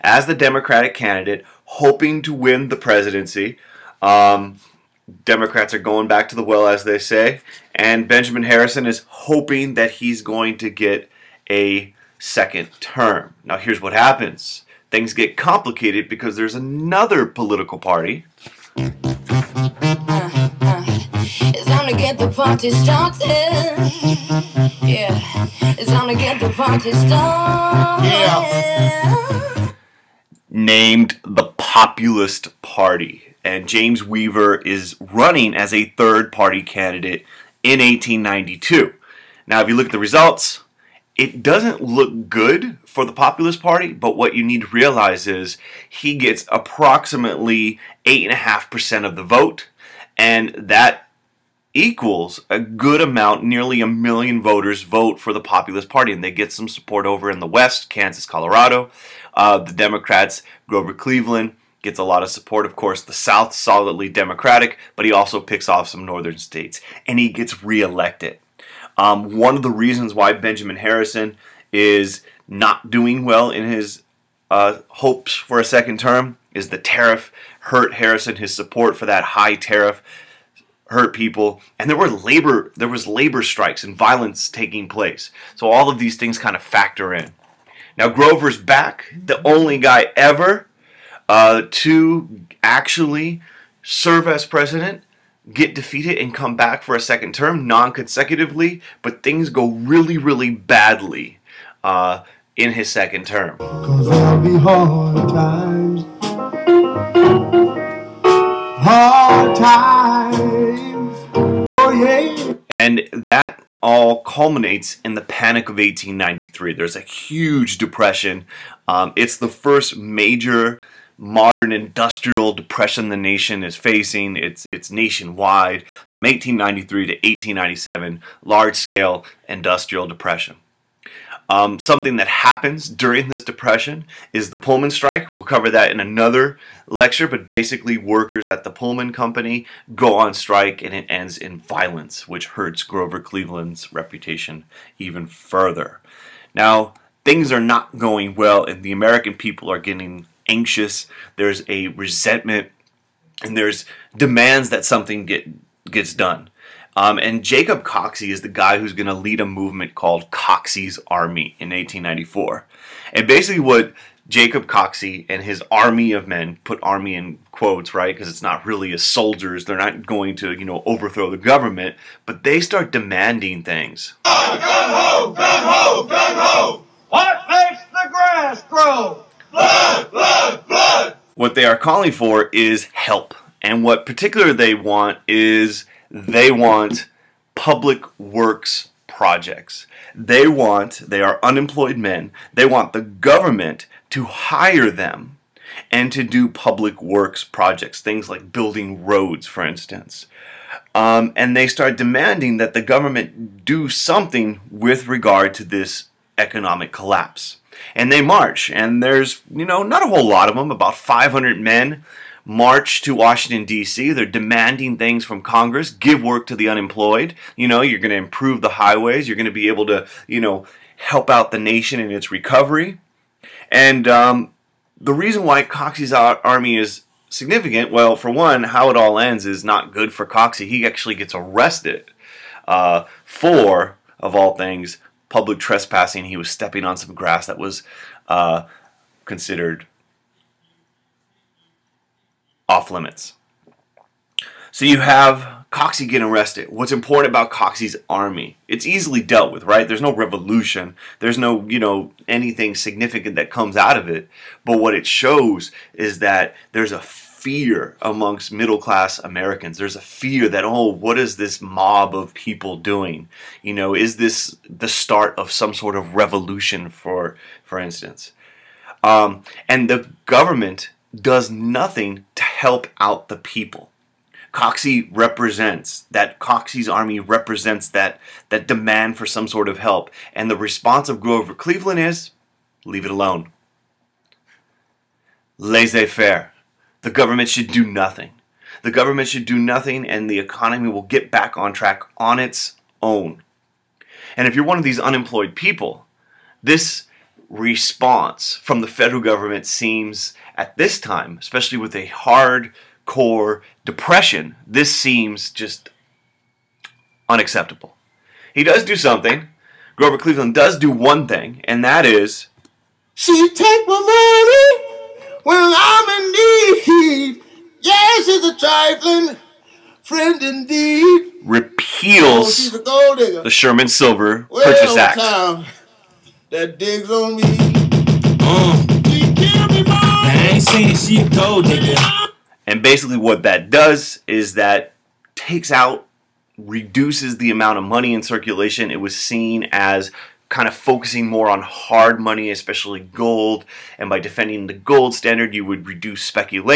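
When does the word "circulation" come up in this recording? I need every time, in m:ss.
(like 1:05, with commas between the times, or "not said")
5:38.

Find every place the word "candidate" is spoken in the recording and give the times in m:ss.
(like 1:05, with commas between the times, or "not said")
0:00, 0:36.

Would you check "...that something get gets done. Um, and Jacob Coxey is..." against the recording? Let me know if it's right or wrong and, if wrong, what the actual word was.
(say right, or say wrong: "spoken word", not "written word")
right.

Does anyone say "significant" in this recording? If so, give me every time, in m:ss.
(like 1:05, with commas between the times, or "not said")
3:47, 4:12.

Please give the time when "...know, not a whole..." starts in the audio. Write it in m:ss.
3:29.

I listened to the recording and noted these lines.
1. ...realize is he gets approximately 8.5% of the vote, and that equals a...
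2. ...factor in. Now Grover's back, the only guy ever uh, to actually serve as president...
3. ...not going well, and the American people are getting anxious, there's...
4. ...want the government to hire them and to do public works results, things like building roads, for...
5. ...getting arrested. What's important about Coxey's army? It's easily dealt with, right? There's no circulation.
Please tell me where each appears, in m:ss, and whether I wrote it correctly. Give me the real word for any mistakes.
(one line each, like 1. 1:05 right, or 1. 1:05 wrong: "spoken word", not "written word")
1. 0:44 right
2. 1:26 right
3. 2:27 right
4. 3:12 wrong: "projects", not "results"
5. 4:06 wrong: "revolution", not "circulation".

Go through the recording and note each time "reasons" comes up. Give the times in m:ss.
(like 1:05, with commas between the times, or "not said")
1:09, 3:45.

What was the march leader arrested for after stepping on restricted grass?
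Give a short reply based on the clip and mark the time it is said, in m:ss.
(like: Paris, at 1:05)
public trespassing, at 3:55.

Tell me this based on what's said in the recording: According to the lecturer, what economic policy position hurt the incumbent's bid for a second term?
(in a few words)
high tariff.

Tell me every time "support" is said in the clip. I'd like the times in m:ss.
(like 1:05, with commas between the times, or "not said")
0:56, 1:02, 1:18.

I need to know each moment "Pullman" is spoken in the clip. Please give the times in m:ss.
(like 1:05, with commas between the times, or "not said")
2:14, 2:18.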